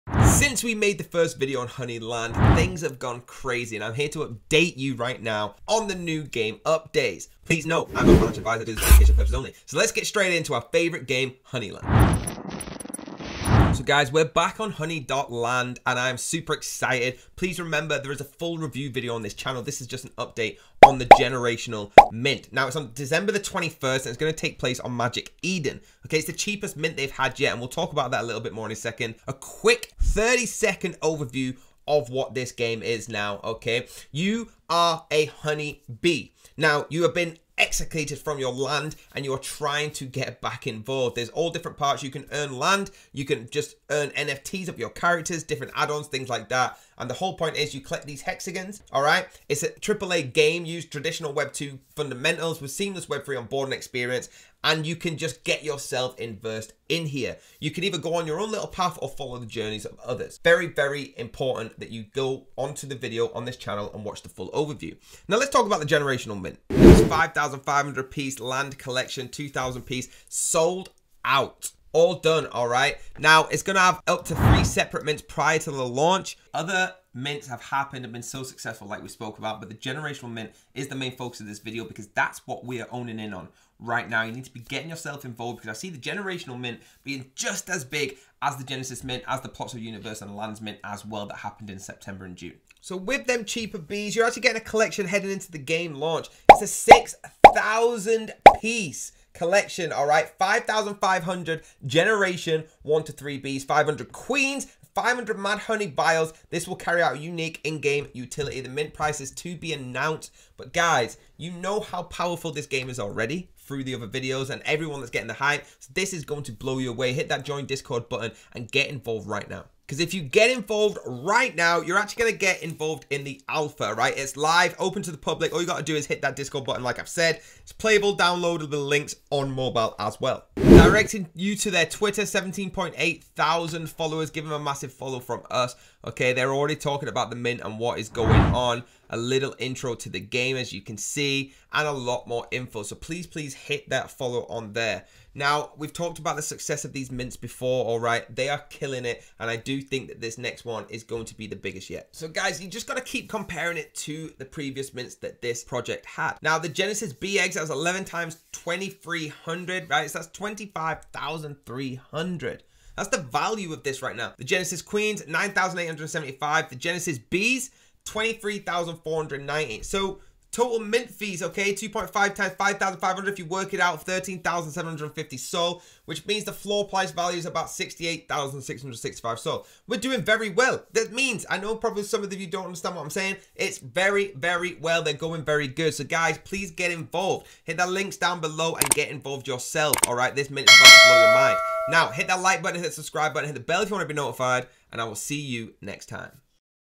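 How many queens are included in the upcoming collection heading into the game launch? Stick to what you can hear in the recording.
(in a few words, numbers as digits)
500.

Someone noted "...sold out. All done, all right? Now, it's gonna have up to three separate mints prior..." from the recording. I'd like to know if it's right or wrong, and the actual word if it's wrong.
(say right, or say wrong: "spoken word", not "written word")
right.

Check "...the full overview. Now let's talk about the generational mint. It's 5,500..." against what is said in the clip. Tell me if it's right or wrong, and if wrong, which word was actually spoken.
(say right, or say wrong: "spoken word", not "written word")
right.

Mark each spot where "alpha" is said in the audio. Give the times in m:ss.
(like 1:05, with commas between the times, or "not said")
2:03.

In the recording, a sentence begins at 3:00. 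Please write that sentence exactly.
That means, I know probably some of you don't understand what I'm saying.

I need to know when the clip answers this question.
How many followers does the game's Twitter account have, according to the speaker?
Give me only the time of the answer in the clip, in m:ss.
2:12.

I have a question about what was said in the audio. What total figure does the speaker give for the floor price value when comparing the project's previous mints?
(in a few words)
68,665.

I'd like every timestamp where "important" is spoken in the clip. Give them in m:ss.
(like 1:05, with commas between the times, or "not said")
1:01.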